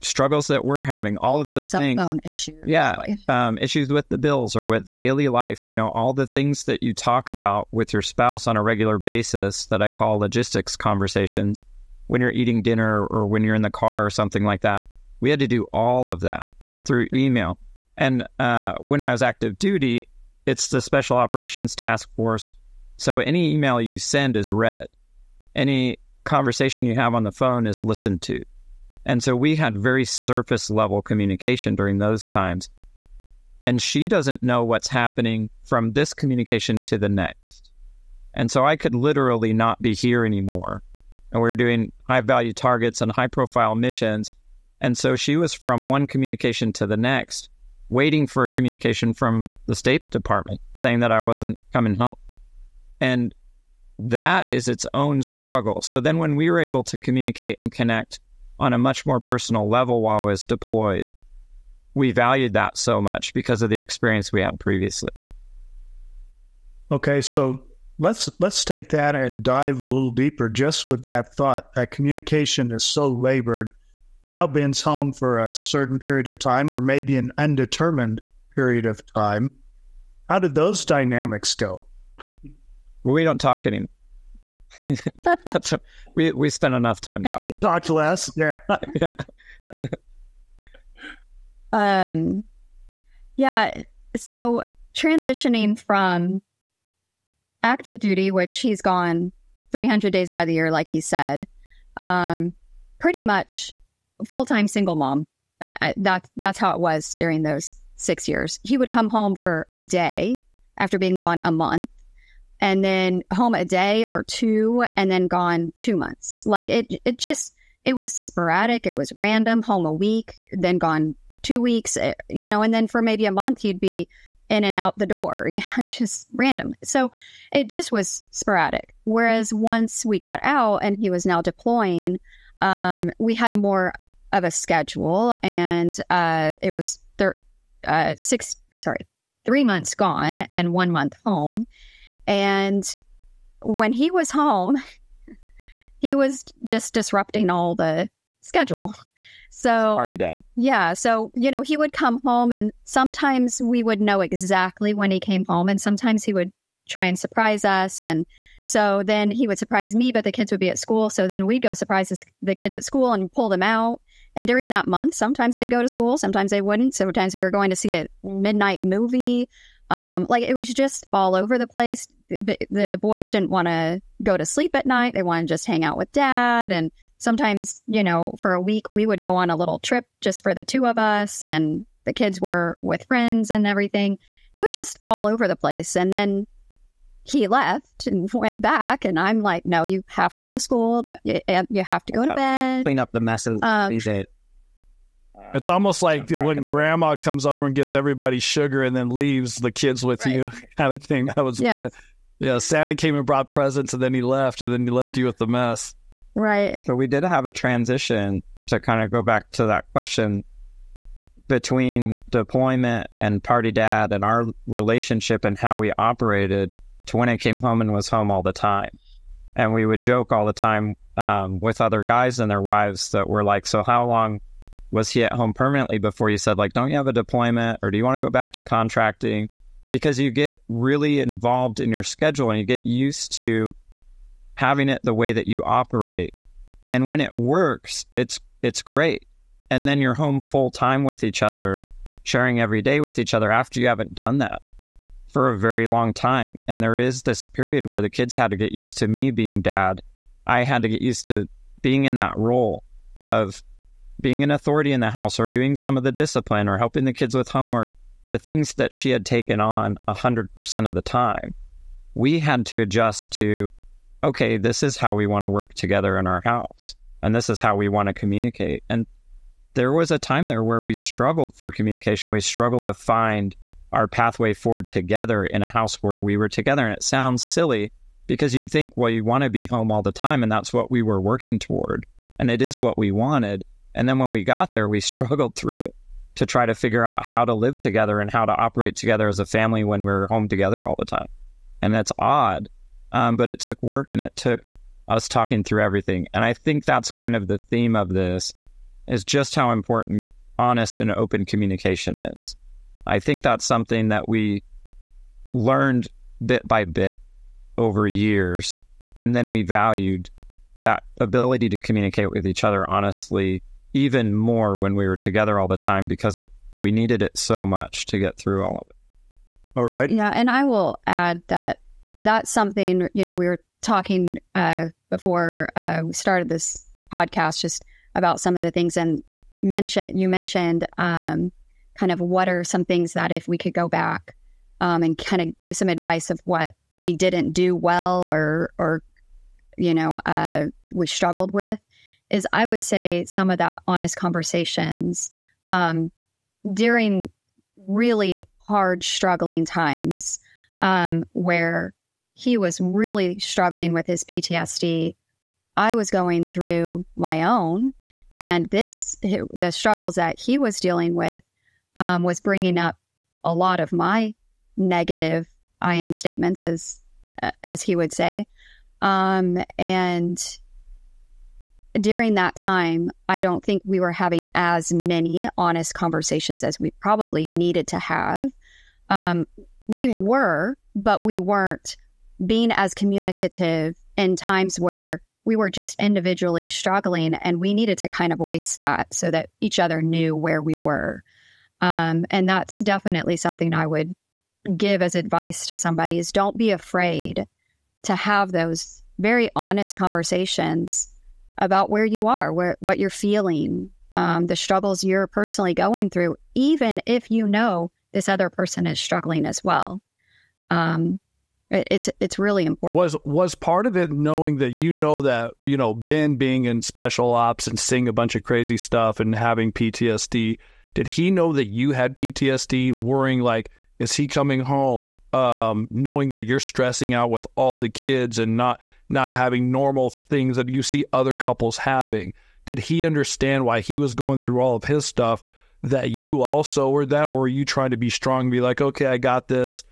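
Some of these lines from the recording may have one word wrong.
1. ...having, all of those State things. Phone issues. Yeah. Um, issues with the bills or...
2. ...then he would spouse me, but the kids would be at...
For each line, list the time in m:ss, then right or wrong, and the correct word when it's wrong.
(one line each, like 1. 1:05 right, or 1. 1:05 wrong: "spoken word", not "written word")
1. 0:00 wrong: "Cell", not "State"
2. 2:39 wrong: "surprise", not "spouse".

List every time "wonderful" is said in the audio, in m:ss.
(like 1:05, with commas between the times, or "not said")
not said.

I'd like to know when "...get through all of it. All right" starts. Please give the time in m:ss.
5:18.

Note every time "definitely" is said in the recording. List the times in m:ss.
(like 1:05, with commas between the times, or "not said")
6:32.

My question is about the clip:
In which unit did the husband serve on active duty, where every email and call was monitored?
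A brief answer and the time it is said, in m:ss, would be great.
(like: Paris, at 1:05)
Special Operations Task Force, at 0:20.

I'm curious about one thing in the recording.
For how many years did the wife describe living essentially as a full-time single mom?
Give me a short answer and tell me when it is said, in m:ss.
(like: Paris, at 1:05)
6, at 1:47.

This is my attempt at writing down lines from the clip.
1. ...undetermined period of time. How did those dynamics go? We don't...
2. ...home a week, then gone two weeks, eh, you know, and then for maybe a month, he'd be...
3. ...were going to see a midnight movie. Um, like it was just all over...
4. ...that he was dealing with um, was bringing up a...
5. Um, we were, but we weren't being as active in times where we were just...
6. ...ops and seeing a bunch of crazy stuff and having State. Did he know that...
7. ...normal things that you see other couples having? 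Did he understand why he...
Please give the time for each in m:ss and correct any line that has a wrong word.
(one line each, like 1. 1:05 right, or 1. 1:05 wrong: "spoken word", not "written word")
1. 1:17 right
2. 1:59 right
3. 2:47 right
4. 6:00 right
5. 6:19 wrong: "communicative", not "active"
6. 6:57 wrong: "PTSD", not "State"
7. 7:09 right.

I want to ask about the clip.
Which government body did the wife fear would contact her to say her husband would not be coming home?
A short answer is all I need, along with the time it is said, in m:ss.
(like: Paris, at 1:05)
State Department, at 0:49.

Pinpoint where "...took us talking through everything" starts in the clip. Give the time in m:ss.
4:54.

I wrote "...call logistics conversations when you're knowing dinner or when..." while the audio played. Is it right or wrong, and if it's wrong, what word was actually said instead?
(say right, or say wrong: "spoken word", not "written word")
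wrong: "eating", not "knowing".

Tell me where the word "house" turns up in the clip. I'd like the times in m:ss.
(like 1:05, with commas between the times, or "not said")
4:15, 4:26, 4:35.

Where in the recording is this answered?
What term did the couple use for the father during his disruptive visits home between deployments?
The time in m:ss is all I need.
3:33.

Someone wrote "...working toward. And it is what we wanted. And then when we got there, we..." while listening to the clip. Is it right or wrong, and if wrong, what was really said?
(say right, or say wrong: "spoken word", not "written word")
right.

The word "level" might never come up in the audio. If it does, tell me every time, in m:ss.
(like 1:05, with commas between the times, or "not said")
0:30, 0:59.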